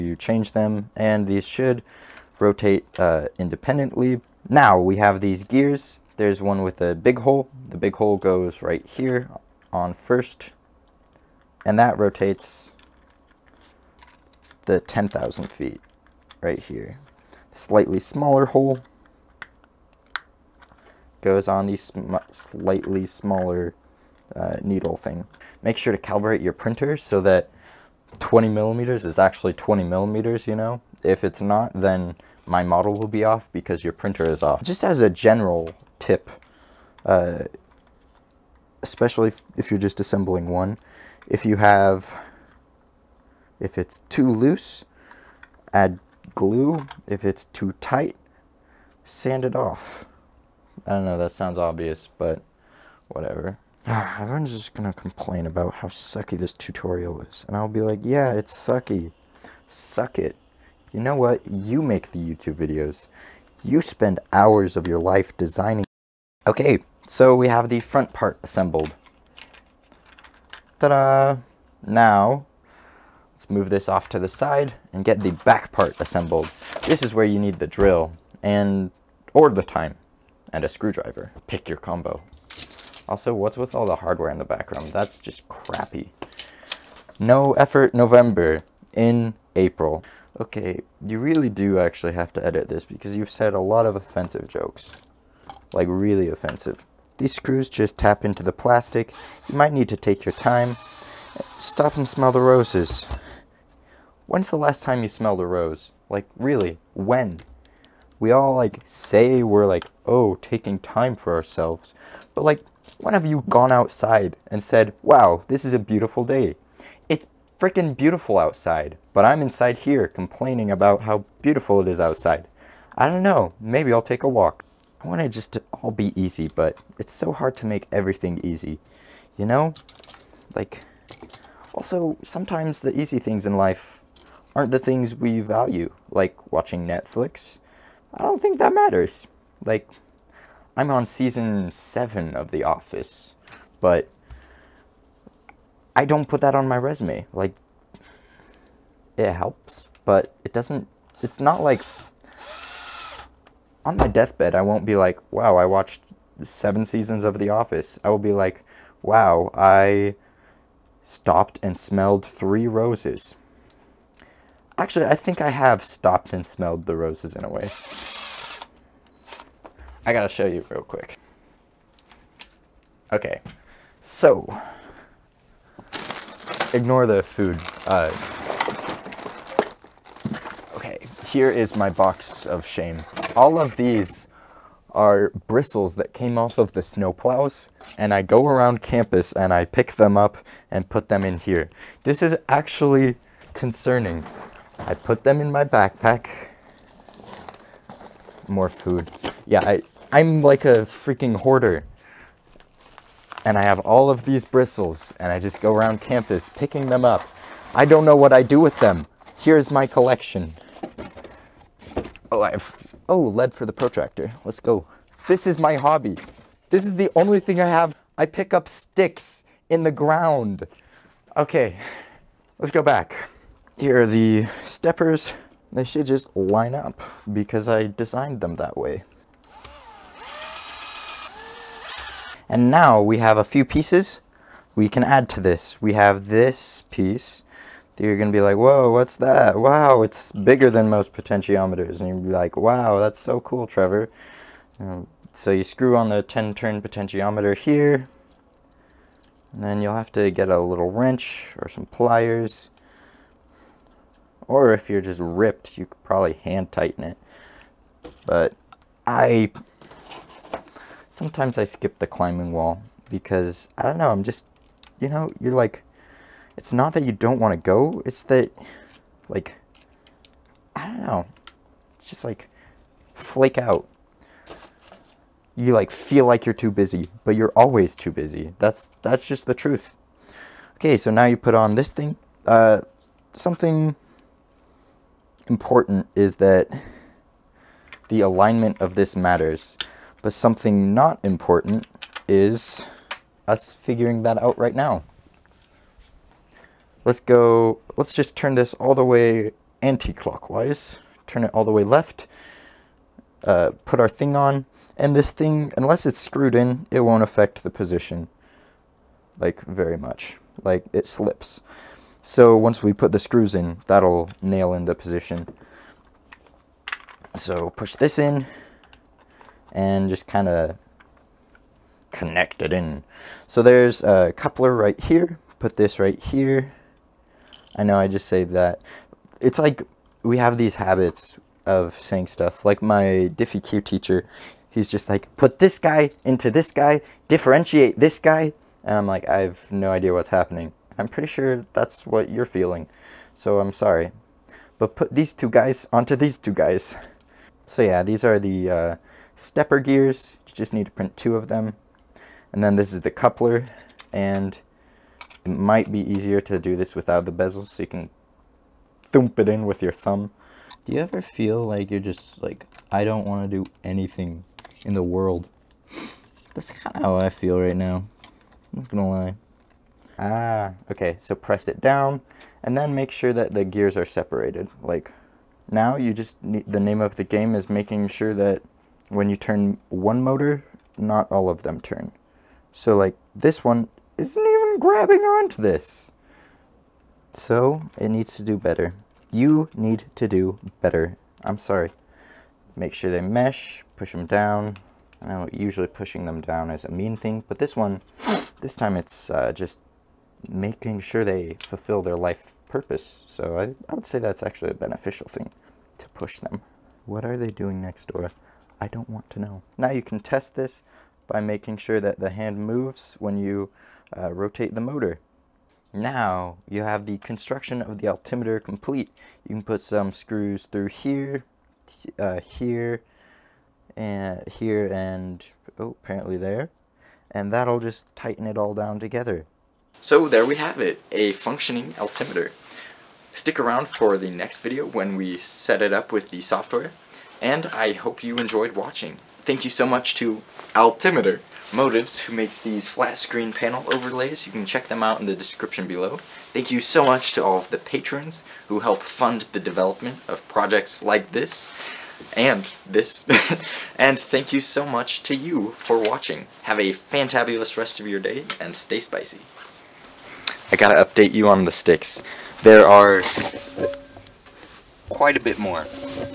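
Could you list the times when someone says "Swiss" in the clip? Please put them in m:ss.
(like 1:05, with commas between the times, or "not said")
not said.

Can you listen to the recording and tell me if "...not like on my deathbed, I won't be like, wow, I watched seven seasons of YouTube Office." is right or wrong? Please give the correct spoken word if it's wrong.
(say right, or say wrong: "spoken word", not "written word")
wrong: "The", not "YouTube".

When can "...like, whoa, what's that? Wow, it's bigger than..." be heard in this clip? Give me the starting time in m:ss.
3:58.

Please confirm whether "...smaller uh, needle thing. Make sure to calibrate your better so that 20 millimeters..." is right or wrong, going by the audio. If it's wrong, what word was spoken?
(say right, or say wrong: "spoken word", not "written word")
wrong: "printer", not "better".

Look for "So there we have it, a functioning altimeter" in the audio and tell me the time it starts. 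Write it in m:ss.
7:10.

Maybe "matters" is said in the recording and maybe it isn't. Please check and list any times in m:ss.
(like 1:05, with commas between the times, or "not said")
2:18, 4:49.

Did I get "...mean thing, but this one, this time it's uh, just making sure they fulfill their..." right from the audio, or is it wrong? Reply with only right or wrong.
right.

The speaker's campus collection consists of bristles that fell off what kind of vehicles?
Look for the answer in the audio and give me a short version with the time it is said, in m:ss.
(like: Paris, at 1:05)
snowplows, at 3:06.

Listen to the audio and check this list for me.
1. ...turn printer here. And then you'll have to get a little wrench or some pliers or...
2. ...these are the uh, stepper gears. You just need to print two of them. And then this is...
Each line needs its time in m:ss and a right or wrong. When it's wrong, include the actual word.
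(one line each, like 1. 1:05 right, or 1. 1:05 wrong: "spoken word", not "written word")
1. 4:06 wrong: "potentiometer", not "printer"
2. 5:48 right.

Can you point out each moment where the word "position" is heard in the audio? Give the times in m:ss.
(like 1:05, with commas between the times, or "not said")
5:07, 5:14.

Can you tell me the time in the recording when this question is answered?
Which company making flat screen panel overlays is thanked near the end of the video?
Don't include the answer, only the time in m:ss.
7:20.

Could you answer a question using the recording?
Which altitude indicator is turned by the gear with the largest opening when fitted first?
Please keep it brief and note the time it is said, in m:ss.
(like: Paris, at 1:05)
10,000 feet, at 0:14.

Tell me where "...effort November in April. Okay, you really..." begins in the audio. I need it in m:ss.
1:27.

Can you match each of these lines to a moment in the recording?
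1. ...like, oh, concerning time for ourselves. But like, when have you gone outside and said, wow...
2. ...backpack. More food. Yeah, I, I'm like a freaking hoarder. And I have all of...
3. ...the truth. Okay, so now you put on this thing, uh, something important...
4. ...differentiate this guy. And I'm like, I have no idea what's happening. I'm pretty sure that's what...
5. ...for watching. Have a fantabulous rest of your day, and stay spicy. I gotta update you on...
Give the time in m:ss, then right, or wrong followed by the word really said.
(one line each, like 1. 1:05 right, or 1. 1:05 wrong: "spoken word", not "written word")
1. 1:49 wrong: "taking", not "concerning"
2. 3:15 right
3. 4:39 right
4. 5:37 right
5. 7:35 right.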